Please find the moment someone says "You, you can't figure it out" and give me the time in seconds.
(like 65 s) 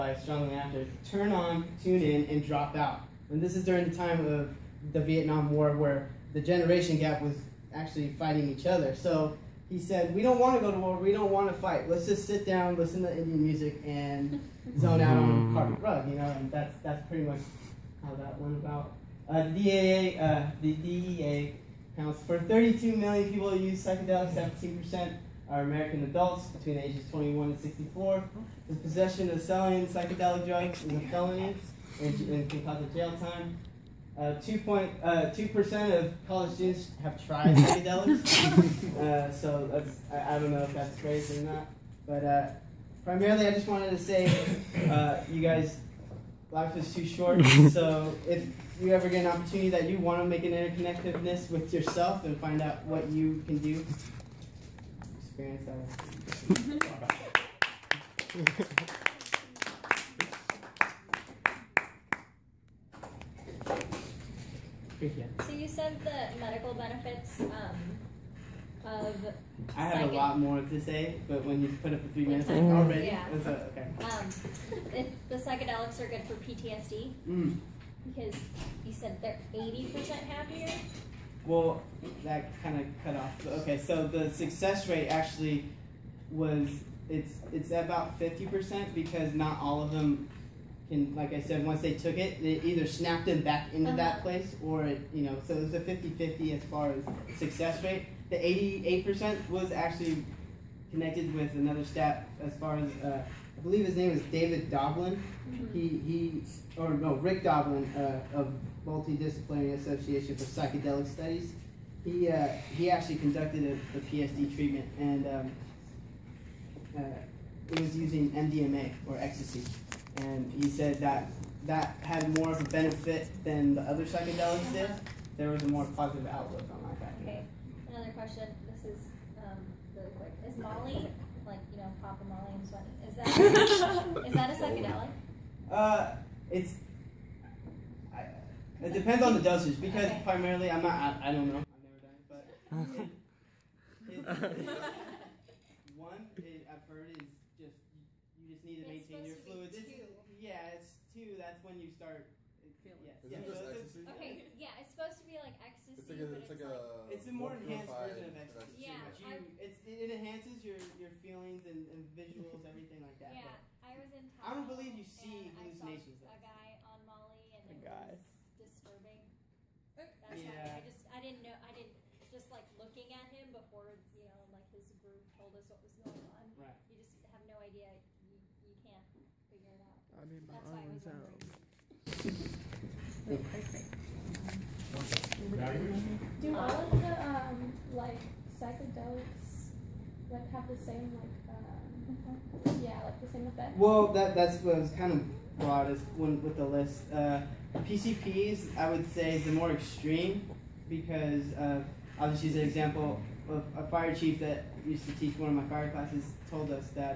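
178 s.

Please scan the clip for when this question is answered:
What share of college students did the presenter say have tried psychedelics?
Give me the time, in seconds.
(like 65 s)
34 s.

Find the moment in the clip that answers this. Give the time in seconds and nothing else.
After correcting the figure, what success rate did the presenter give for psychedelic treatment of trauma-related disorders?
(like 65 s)
88 s.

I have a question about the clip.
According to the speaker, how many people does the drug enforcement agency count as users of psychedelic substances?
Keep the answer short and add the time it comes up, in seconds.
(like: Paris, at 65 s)
32 million, at 22 s.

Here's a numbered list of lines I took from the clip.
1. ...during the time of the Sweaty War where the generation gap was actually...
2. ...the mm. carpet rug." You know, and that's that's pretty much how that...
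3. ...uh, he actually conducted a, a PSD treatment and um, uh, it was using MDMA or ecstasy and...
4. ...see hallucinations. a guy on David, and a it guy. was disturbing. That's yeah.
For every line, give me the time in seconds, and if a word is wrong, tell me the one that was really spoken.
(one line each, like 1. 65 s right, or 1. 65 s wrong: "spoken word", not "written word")
1. 3 s wrong: "Vietnam", not "Sweaty"
2. 15 s right
3. 112 s right
4. 165 s wrong: "Molly", not "David".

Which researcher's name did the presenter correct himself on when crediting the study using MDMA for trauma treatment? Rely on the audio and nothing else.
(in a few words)
Rick Doblin.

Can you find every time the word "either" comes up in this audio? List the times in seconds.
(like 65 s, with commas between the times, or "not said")
92 s.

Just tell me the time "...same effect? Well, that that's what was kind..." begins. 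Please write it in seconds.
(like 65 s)
193 s.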